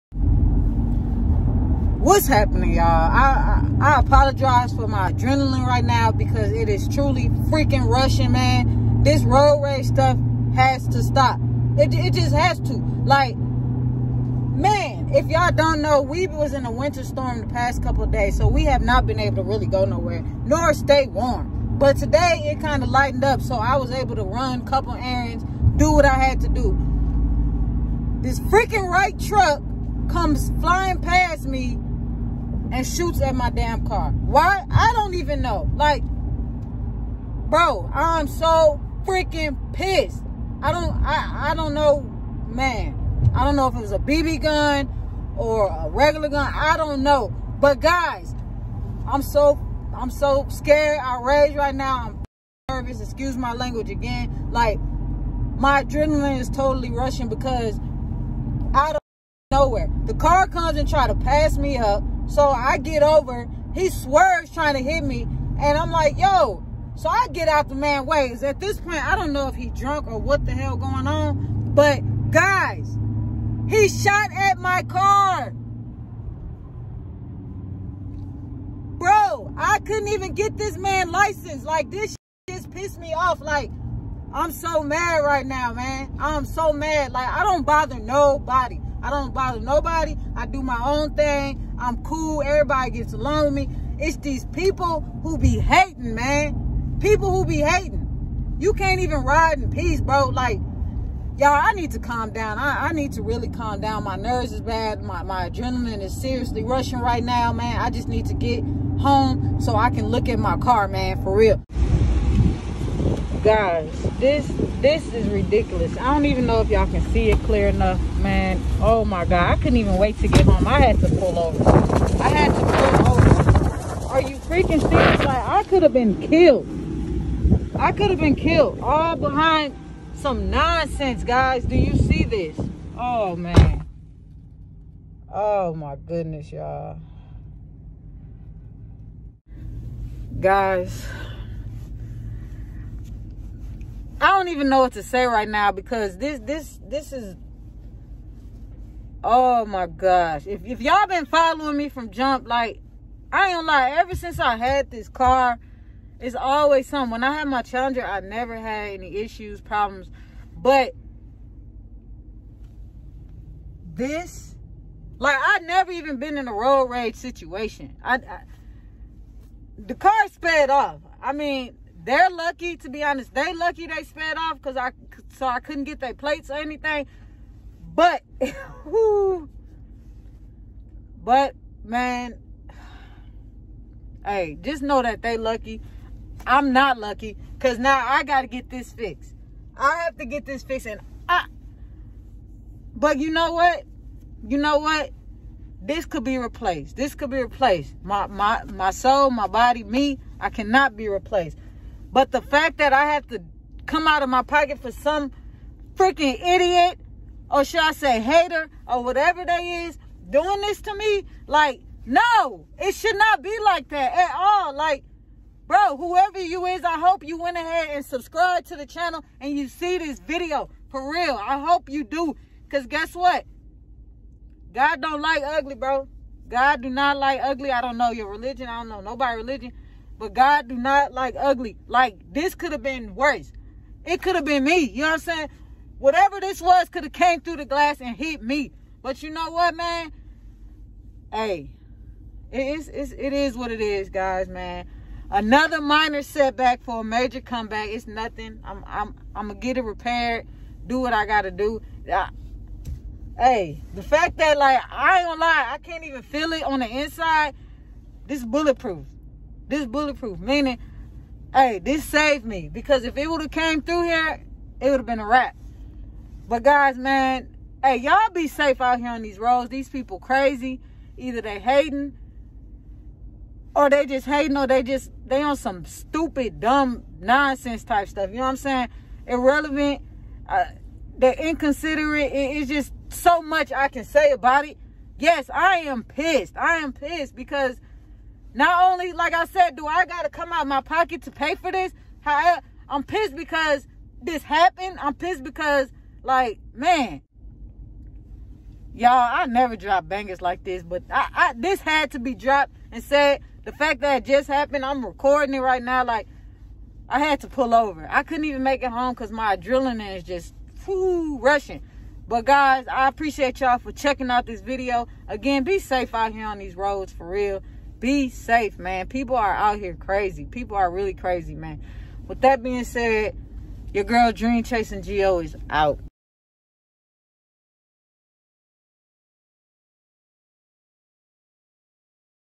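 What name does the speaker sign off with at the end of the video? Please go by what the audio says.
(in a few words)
Dream Chasing Gio.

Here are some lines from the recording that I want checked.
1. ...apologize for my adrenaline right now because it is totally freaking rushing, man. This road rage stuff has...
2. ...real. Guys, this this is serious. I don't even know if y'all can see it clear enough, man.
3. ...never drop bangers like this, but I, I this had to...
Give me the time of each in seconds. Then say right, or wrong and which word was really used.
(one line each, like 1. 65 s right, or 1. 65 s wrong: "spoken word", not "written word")
1. 3 s wrong: "truly", not "totally"
2. 111 s wrong: "ridiculous", not "serious"
3. 299 s right.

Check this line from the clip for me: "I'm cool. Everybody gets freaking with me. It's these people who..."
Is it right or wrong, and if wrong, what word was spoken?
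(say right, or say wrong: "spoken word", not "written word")
wrong: "along", not "freaking".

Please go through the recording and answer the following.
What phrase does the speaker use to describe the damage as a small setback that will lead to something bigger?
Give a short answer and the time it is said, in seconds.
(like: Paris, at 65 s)
Minor setback for a major comeback, at 245 s.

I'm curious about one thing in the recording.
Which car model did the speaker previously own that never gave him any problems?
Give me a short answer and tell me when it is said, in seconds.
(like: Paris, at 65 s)
Challenger, at 157 s.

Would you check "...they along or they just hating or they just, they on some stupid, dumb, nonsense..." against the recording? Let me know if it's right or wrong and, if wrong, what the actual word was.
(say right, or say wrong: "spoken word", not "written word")
wrong: "hating", not "along".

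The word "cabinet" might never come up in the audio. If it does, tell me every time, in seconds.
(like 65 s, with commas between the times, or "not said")
not said.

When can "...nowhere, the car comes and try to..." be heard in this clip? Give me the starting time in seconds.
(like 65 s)
59 s.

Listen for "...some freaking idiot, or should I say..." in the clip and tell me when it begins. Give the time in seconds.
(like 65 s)
204 s.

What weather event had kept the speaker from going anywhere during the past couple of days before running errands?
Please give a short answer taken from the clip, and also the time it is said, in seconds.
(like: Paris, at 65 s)
Winter storm, at 16 s.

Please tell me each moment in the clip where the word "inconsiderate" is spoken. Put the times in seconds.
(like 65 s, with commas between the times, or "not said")
281 s.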